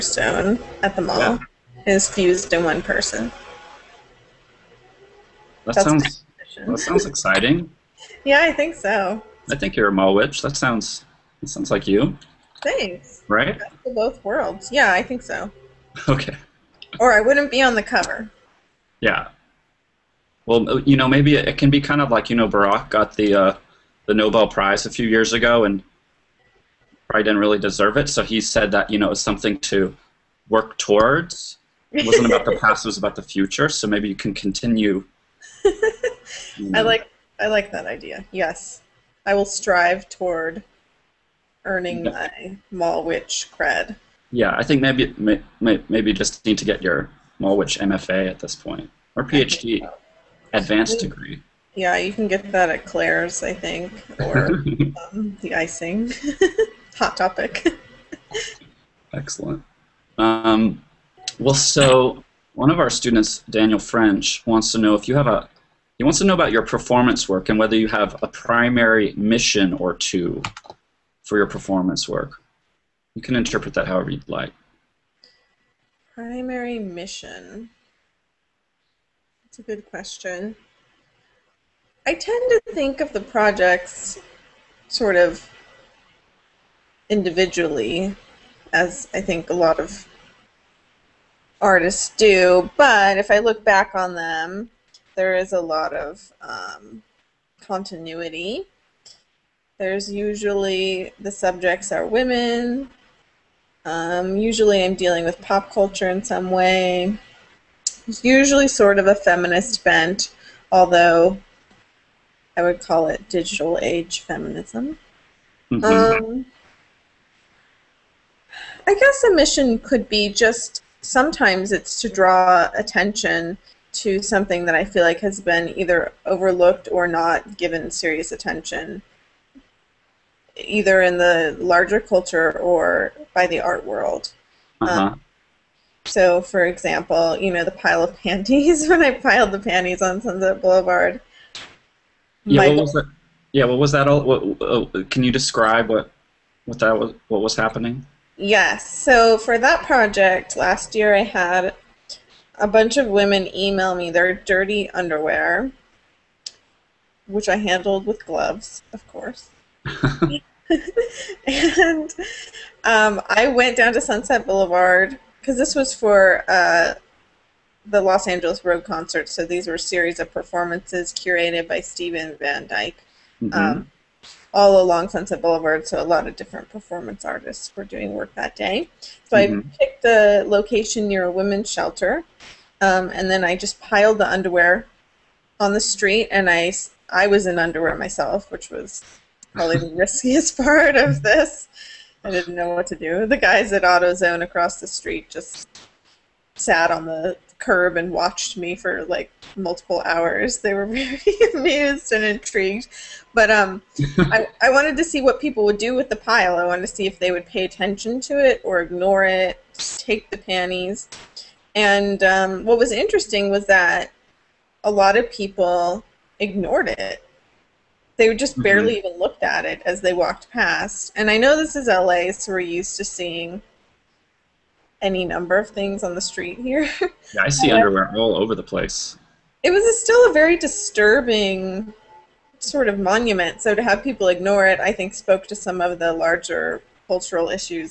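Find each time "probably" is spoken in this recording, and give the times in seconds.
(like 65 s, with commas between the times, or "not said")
27 s, 189 s.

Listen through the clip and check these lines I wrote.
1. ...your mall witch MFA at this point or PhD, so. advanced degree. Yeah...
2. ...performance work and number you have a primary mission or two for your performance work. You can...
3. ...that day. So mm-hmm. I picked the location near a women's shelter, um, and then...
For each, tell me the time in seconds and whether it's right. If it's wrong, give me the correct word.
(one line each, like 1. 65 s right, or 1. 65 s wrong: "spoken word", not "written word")
1. 46 s right
2. 66 s wrong: "whether", not "number"
3. 178 s right.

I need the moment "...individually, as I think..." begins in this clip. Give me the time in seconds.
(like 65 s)
87 s.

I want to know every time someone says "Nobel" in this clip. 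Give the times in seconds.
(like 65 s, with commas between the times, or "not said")
24 s.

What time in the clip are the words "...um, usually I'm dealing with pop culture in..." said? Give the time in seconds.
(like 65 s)
103 s.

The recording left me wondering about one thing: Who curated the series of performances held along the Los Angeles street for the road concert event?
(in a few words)
Stephen Van Dyke.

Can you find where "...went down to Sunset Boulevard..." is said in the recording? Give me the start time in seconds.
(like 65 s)
163 s.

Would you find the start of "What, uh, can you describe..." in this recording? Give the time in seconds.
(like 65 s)
144 s.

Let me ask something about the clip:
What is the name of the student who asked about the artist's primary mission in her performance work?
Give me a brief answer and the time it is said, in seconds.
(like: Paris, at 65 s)
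Daniel French, at 63 s.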